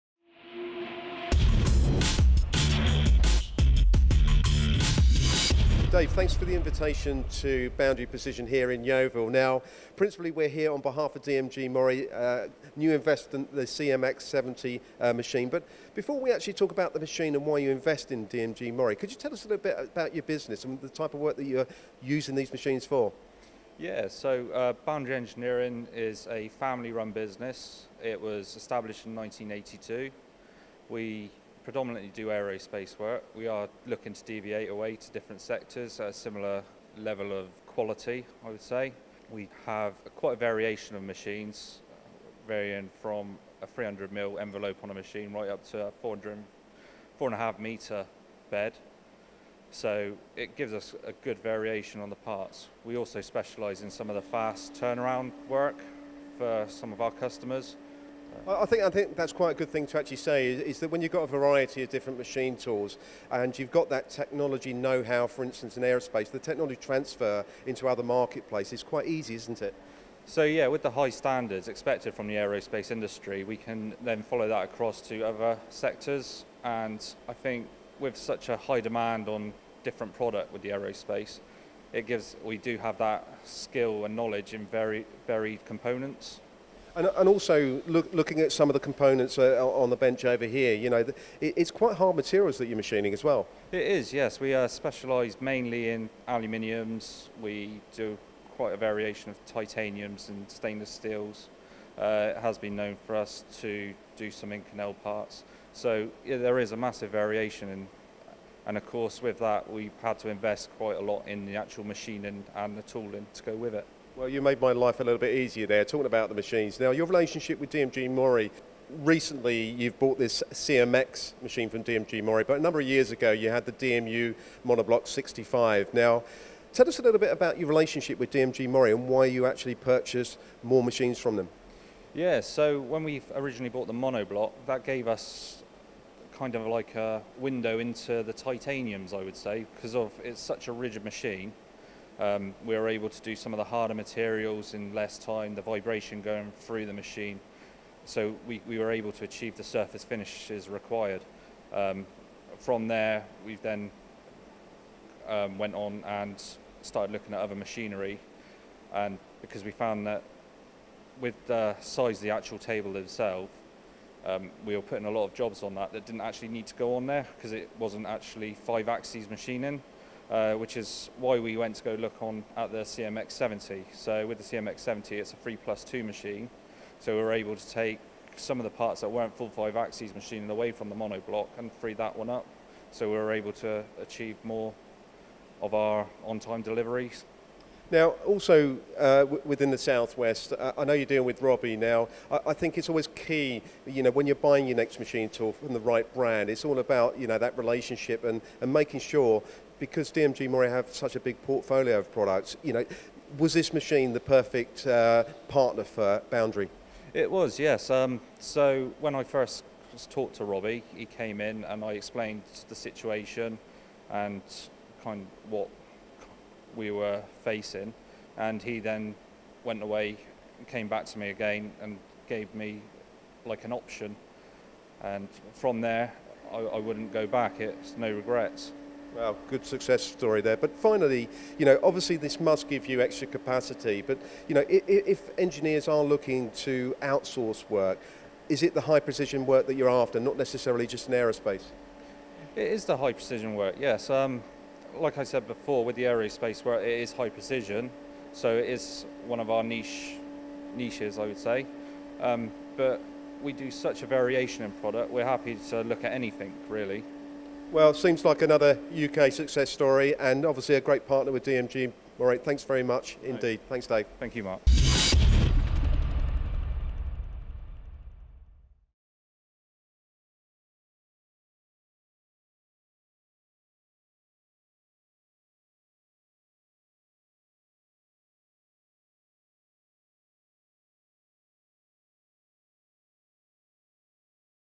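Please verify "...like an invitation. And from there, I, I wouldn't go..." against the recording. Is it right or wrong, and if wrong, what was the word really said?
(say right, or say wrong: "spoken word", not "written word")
wrong: "option", not "invitation".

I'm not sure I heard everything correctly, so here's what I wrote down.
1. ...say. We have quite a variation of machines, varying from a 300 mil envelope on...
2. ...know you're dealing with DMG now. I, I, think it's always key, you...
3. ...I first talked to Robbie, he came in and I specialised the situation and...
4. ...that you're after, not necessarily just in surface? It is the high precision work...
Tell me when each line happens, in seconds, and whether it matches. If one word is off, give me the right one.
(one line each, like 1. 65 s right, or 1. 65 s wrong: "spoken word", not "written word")
1. 38 s right
2. 190 s wrong: "Robbie", not "DMG"
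3. 209 s wrong: "explained", not "specialised"
4. 239 s wrong: "aerospace", not "surface".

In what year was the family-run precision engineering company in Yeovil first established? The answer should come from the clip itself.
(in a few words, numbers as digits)
1982.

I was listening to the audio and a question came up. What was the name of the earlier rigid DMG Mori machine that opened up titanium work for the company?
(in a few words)
DMU Monoblock 65.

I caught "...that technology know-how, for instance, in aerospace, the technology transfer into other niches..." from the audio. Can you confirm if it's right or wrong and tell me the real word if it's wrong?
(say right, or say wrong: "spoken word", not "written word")
wrong: "marketplaces", not "niches".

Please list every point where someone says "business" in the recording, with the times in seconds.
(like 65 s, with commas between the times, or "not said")
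20 s, 27 s.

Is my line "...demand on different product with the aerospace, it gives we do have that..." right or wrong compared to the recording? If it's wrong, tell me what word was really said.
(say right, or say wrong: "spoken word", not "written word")
right.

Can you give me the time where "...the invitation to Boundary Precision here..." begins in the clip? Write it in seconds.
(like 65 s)
6 s.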